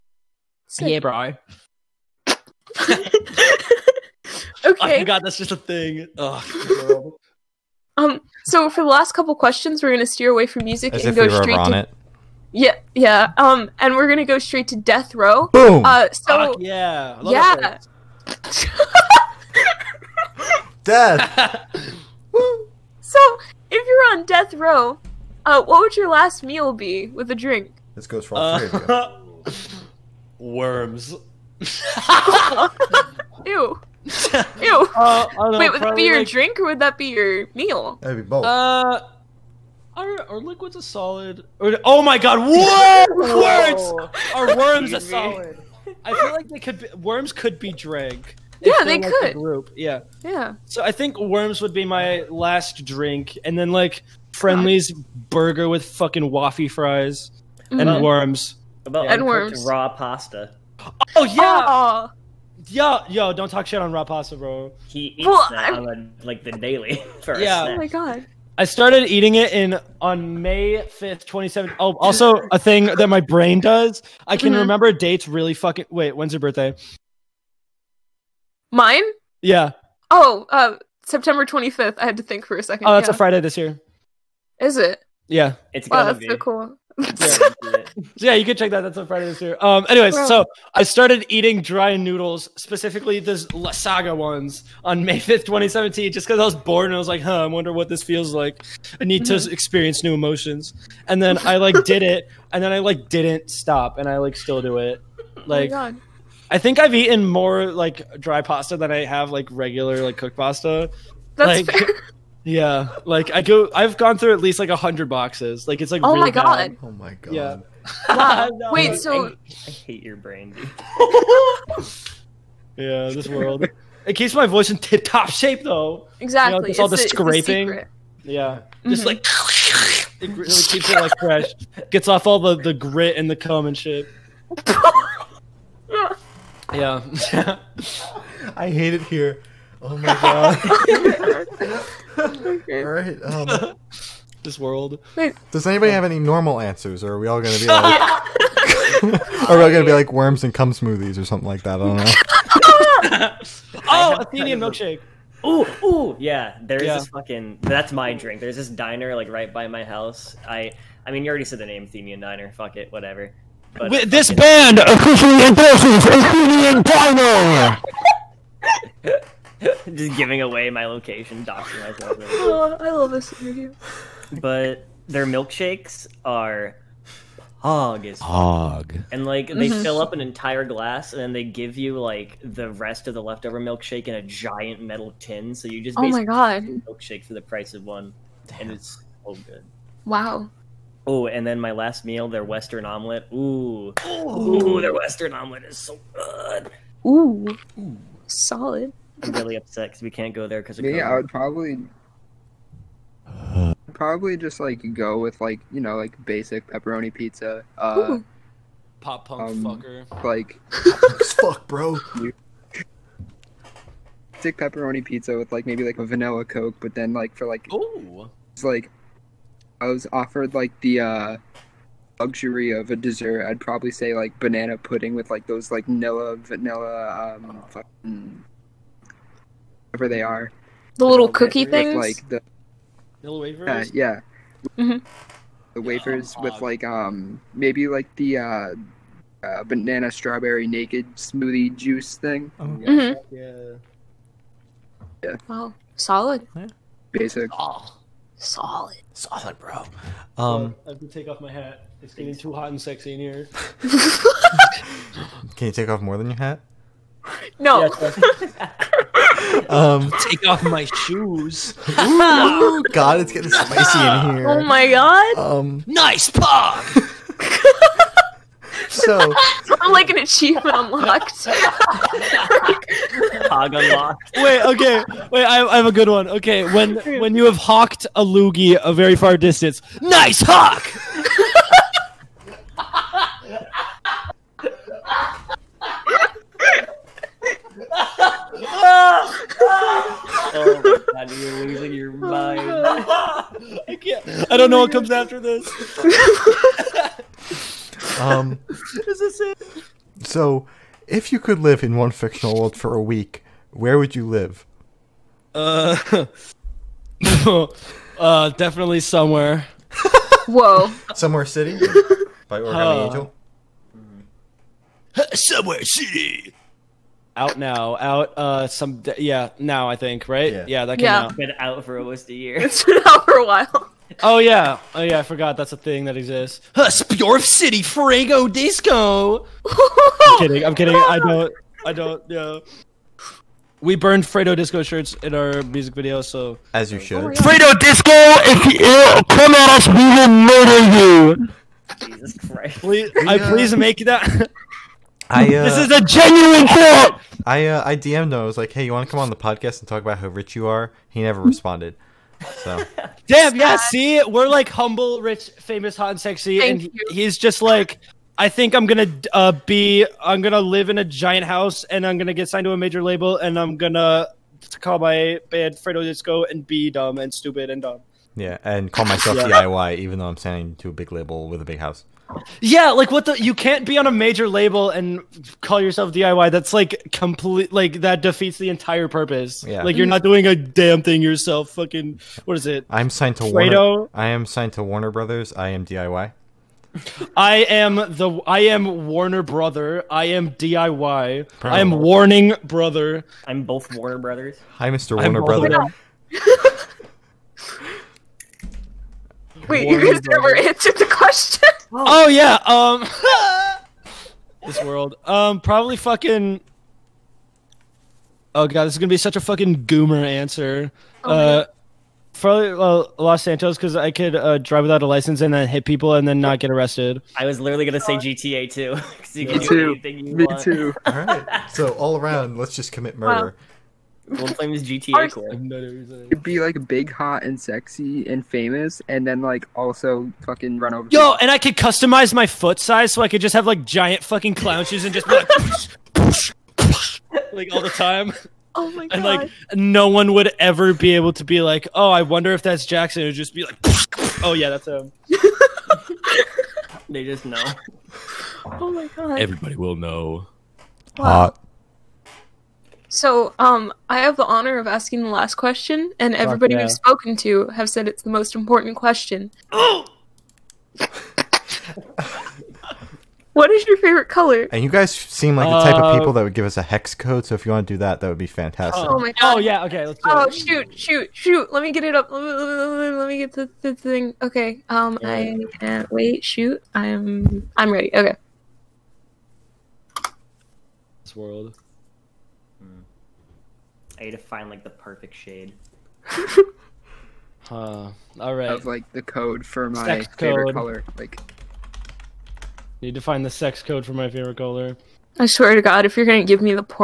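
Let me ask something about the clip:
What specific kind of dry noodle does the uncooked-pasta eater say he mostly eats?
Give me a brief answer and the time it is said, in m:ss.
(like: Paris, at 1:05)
Lasagna, at 1:33.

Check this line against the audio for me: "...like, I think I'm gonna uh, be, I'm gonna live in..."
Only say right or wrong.
right.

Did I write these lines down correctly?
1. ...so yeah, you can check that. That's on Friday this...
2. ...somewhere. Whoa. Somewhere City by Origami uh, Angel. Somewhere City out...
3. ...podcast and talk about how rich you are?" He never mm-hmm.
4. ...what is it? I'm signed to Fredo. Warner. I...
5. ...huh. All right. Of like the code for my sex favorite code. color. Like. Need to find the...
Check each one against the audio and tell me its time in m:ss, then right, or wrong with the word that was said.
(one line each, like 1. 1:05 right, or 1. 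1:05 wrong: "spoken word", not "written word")
1. 1:27 right
2. 5:09 right
3. 5:49 right
4. 6:22 right
5. 8:06 right.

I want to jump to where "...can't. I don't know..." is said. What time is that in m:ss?
4:54.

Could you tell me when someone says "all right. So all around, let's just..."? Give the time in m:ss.
7:01.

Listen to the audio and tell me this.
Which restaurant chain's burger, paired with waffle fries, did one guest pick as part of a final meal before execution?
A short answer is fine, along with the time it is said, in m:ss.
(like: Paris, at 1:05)
Friendly's, at 0:54.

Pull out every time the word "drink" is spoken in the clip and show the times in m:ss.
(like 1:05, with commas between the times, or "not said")
0:27, 0:36, 0:52, 2:38.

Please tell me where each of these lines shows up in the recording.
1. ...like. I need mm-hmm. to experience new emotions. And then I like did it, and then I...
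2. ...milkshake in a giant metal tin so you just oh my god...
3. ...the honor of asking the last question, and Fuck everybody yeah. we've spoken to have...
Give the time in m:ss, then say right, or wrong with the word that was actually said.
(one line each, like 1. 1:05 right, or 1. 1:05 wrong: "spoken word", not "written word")
1. 1:38 right
2. 3:03 right
3. 7:34 right.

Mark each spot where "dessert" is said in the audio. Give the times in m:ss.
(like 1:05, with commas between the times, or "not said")
3:42.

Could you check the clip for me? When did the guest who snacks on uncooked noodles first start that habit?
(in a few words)
May 5th, 2017.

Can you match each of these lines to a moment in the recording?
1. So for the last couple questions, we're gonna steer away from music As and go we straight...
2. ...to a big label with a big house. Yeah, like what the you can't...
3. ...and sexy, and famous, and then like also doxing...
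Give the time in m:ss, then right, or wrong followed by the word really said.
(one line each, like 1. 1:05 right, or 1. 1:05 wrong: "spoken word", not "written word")
1. 0:08 right
2. 6:10 right
3. 7:07 wrong: "fucking", not "doxing".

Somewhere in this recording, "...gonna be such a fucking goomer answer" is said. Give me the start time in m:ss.
6:48.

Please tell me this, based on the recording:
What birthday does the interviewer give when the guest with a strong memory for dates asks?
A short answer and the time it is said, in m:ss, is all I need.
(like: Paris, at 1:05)
September 25th, at 1:21.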